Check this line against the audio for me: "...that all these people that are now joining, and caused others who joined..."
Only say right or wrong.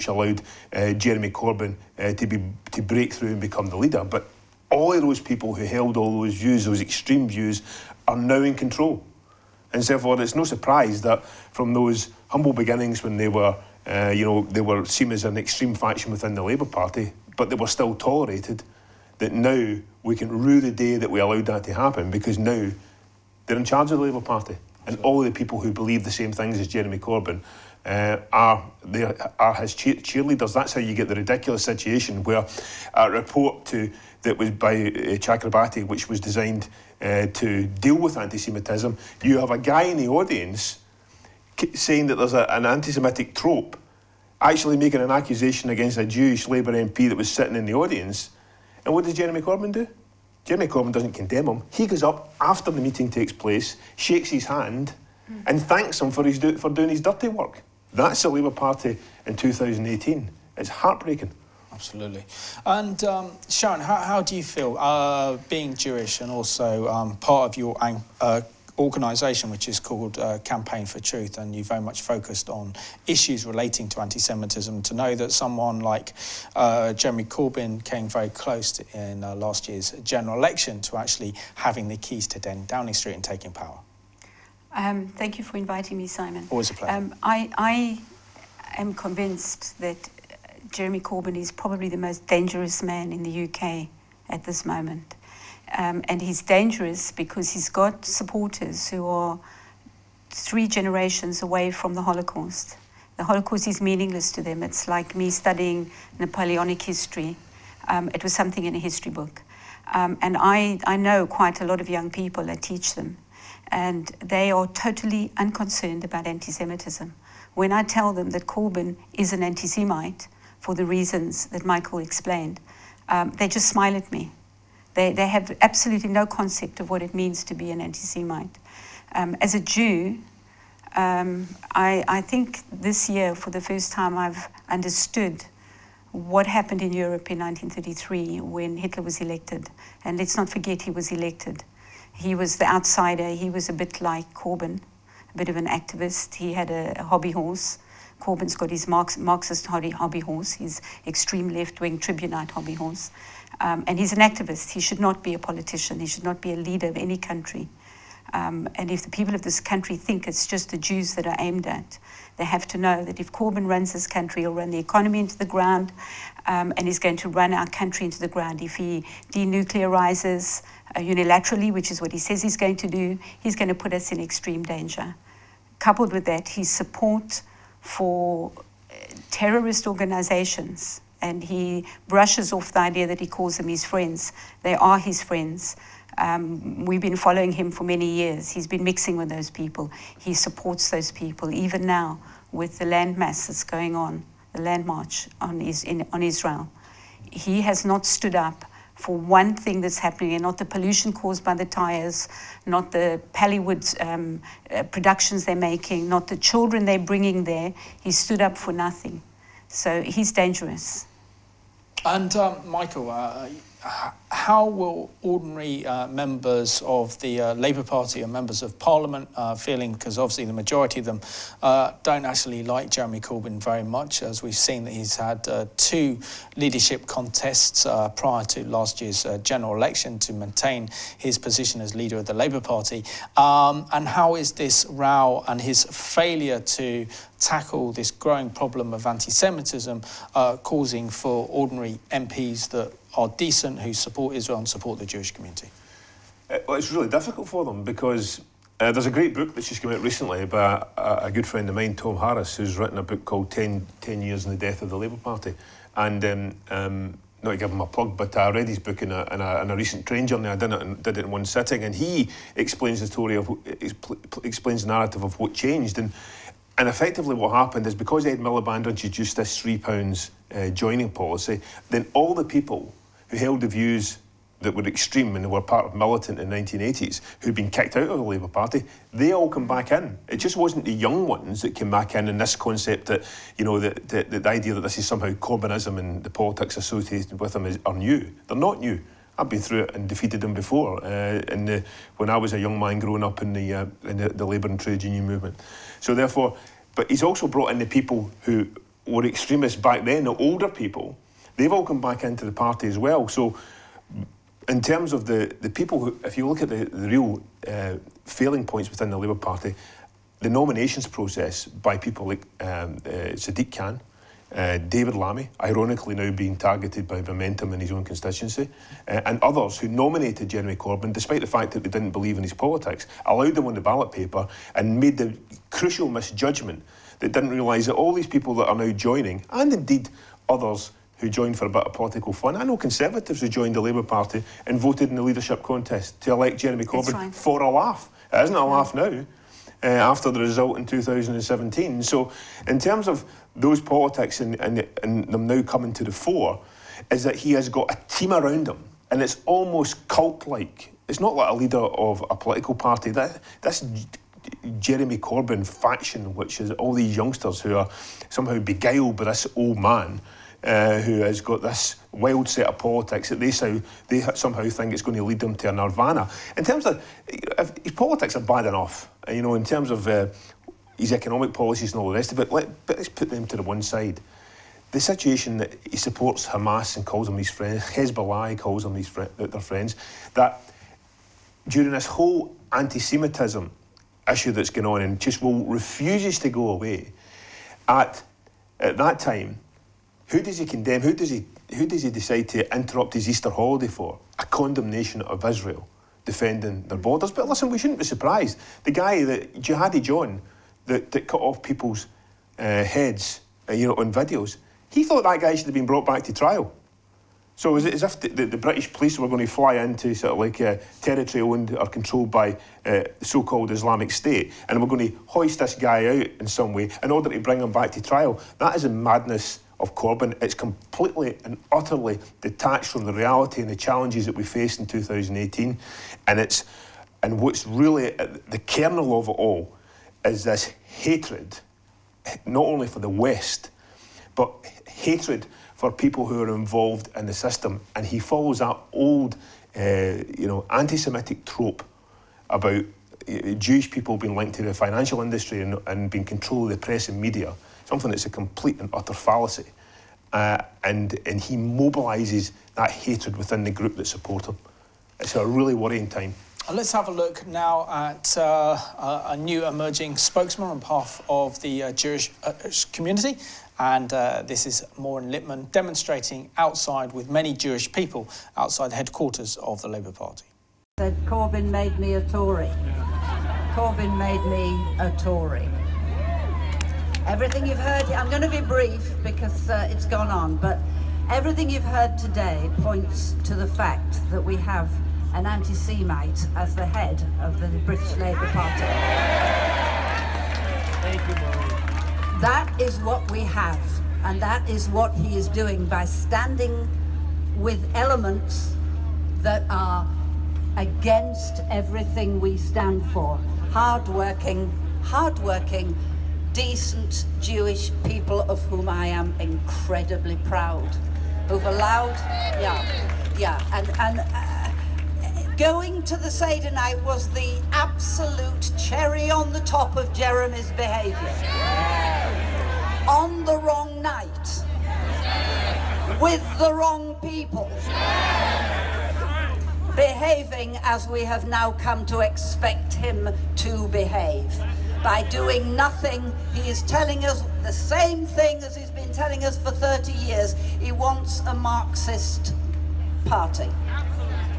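wrong.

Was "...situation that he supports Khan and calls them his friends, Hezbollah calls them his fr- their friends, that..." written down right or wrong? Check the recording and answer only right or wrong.
wrong.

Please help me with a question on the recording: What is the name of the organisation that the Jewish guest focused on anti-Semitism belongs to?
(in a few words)
Campaign for Truth.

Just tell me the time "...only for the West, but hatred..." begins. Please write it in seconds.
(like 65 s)
432 s.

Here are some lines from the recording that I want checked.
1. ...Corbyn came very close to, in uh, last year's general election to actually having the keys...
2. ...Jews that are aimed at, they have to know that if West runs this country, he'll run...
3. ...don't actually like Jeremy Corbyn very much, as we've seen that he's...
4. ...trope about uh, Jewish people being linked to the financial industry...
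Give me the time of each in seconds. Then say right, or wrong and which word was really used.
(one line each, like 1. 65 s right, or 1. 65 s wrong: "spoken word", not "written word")
1. 77 s right
2. 160 s wrong: "Corbyn", not "West"
3. 222 s right
4. 441 s right.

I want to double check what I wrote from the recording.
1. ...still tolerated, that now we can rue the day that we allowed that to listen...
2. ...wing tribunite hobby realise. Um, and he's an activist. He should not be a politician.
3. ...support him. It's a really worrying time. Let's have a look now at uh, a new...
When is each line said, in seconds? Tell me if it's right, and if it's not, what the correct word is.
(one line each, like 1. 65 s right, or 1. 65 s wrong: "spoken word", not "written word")
1. 17 s wrong: "happen", not "listen"
2. 151 s wrong: "horse", not "realise"
3. 454 s right.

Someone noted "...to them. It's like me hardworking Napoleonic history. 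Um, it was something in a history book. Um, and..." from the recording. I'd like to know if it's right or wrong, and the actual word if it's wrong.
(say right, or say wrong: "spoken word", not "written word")
wrong: "studying", not "hardworking".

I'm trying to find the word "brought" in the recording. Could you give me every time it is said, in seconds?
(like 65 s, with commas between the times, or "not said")
297 s, 405 s.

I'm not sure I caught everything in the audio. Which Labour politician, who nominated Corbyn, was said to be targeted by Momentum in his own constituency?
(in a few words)
David Lammy.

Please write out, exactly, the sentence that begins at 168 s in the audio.
If he denuclearizes uh, unilaterally, which is what he says he's going to do, he's going to put us in extreme danger.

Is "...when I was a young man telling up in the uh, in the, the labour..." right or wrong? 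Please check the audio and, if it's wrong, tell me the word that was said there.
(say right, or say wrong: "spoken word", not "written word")
wrong: "growing", not "telling".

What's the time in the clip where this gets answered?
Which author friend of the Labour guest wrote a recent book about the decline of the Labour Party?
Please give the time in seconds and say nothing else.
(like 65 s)
251 s.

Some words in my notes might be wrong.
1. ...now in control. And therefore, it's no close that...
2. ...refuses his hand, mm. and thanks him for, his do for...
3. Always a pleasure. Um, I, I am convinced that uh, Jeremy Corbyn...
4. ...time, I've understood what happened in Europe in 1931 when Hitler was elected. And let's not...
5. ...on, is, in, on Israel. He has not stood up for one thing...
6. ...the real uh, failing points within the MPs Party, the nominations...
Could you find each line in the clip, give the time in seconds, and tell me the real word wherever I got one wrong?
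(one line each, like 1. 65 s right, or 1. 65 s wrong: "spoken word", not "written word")
1. 8 s wrong: "surprise", not "close"
2. 53 s wrong: "shakes", not "refuses"
3. 86 s right
4. 133 s wrong: "1933", not "1931"
5. 195 s right
6. 306 s wrong: "Labour", not "MPs".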